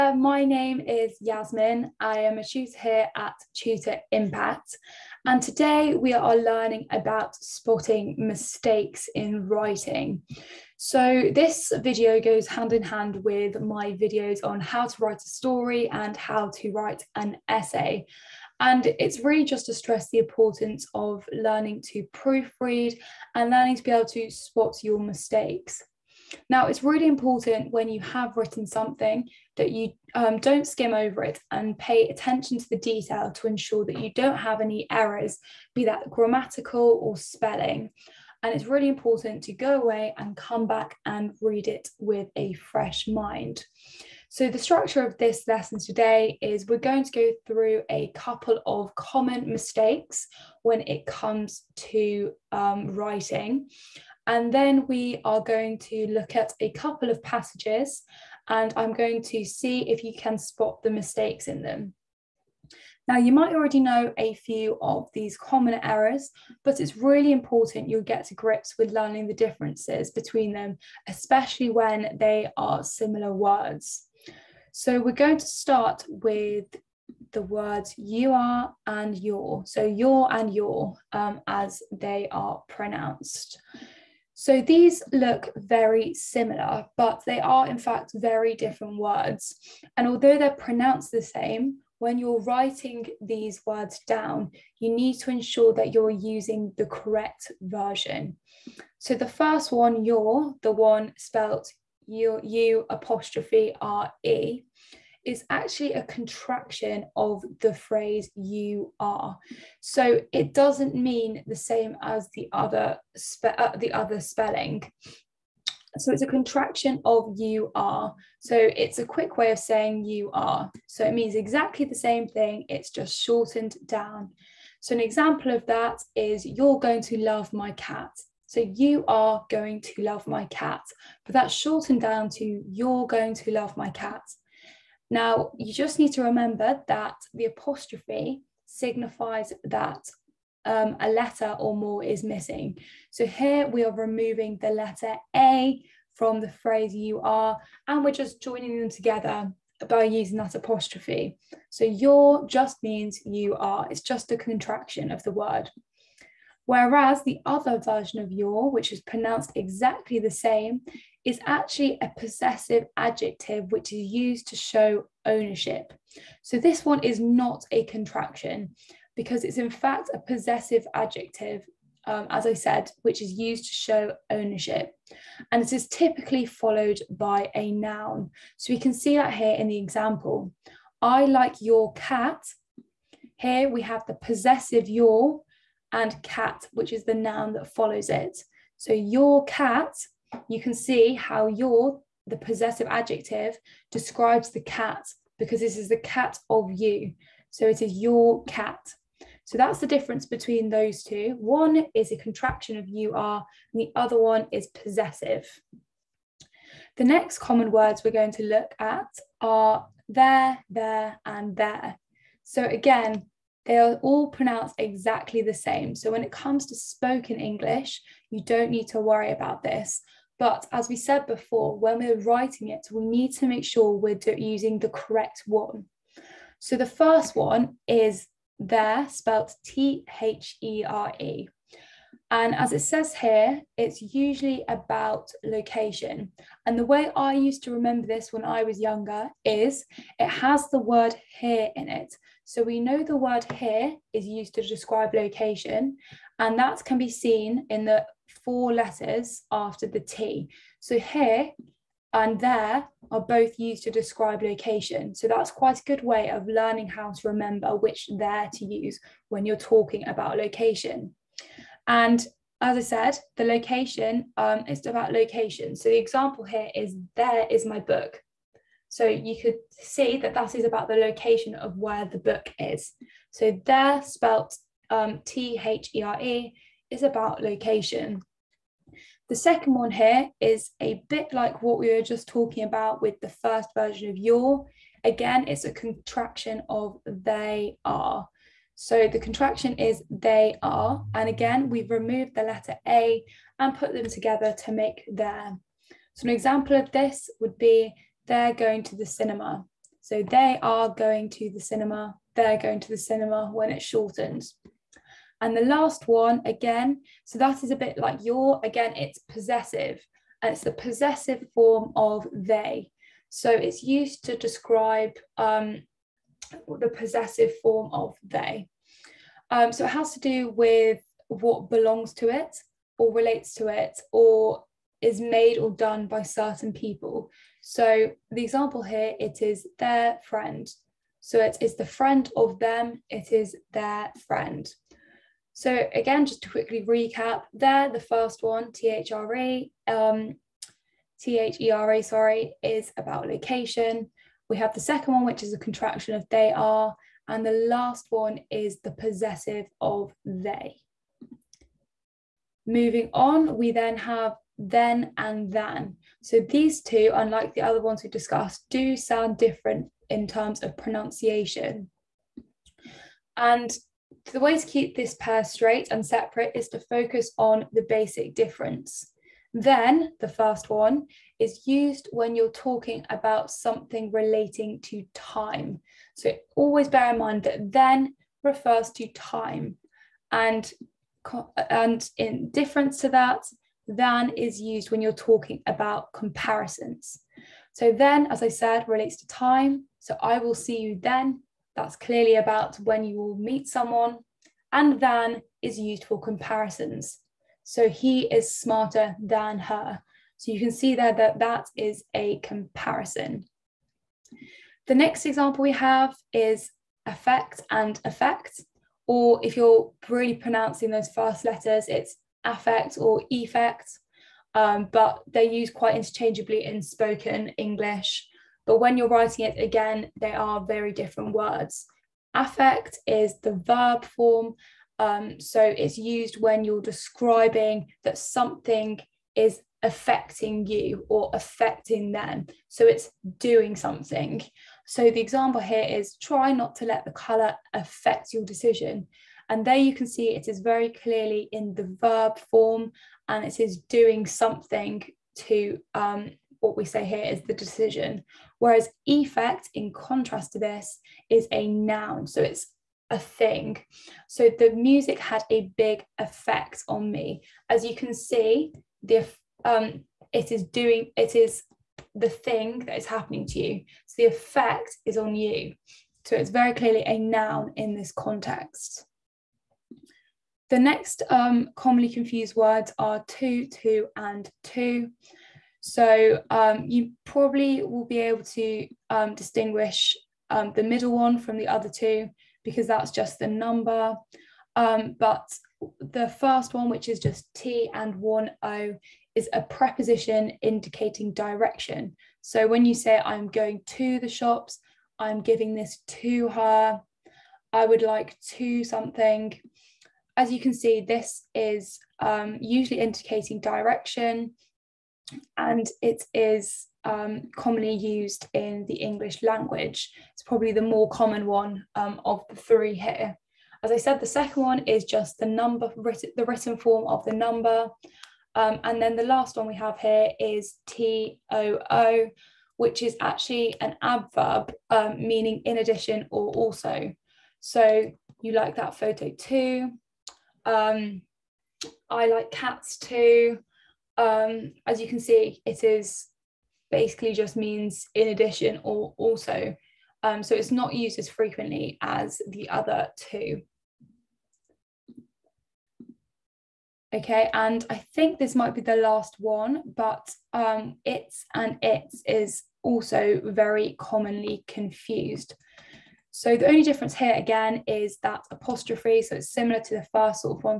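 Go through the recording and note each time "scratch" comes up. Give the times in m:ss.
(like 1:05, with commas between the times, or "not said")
not said.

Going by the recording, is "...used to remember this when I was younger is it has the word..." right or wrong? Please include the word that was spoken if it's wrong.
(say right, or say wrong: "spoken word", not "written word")
right.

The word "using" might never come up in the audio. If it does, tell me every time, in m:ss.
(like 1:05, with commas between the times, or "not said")
1:36, 2:30, 3:44.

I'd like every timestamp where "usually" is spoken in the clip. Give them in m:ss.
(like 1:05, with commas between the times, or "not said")
3:54, 8:22.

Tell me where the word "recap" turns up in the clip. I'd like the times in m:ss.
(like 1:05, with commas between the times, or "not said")
5:36.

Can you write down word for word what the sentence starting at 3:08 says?
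So your cat you can see how your, the possessive adjective, describes the cat because this is the cat of you.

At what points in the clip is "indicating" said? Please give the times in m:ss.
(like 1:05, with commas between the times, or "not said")
8:10, 8:23.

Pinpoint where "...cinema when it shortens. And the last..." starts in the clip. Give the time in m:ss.
5:03.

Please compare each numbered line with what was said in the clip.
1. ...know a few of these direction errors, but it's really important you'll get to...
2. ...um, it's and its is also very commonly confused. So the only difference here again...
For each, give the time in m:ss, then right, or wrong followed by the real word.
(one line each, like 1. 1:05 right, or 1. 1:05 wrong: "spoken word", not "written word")
1. 1:03 wrong: "common", not "direction"
2. 9:10 right.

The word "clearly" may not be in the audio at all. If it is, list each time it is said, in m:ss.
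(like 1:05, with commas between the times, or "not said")
6:31, 7:20, 7:46.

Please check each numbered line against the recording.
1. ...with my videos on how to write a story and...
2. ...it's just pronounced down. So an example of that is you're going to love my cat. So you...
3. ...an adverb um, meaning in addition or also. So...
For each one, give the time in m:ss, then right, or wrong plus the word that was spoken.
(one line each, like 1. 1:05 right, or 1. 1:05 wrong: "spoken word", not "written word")
1. 0:13 right
2. 2:02 wrong: "shortened", not "pronounced"
3. 8:43 right.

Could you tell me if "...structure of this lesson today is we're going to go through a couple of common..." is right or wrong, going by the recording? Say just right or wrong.
right.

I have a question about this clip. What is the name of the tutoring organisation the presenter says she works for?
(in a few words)
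Tutor Impact.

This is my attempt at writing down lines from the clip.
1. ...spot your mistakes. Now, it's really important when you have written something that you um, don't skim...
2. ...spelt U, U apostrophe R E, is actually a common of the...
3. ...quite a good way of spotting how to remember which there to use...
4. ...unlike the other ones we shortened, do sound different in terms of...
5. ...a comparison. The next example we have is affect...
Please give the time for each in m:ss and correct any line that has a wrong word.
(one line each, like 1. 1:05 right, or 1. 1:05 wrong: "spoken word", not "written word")
1. 0:24 right
2. 1:41 wrong: "contraction", not "common"
3. 4:15 wrong: "learning", not "spotting"
4. 5:57 wrong: "discussed", not "shortened"
5. 6:42 right.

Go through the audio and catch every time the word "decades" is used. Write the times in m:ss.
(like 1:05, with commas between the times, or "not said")
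not said.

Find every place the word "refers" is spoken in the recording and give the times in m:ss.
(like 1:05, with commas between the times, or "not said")
6:18.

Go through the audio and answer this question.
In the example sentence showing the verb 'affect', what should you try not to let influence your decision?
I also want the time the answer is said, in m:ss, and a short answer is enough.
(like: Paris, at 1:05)
the colour, at 7:17.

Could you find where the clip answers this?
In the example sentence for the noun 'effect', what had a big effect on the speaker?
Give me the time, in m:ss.
7:34.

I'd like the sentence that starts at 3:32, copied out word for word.
So again, they are all pronounced exactly the same.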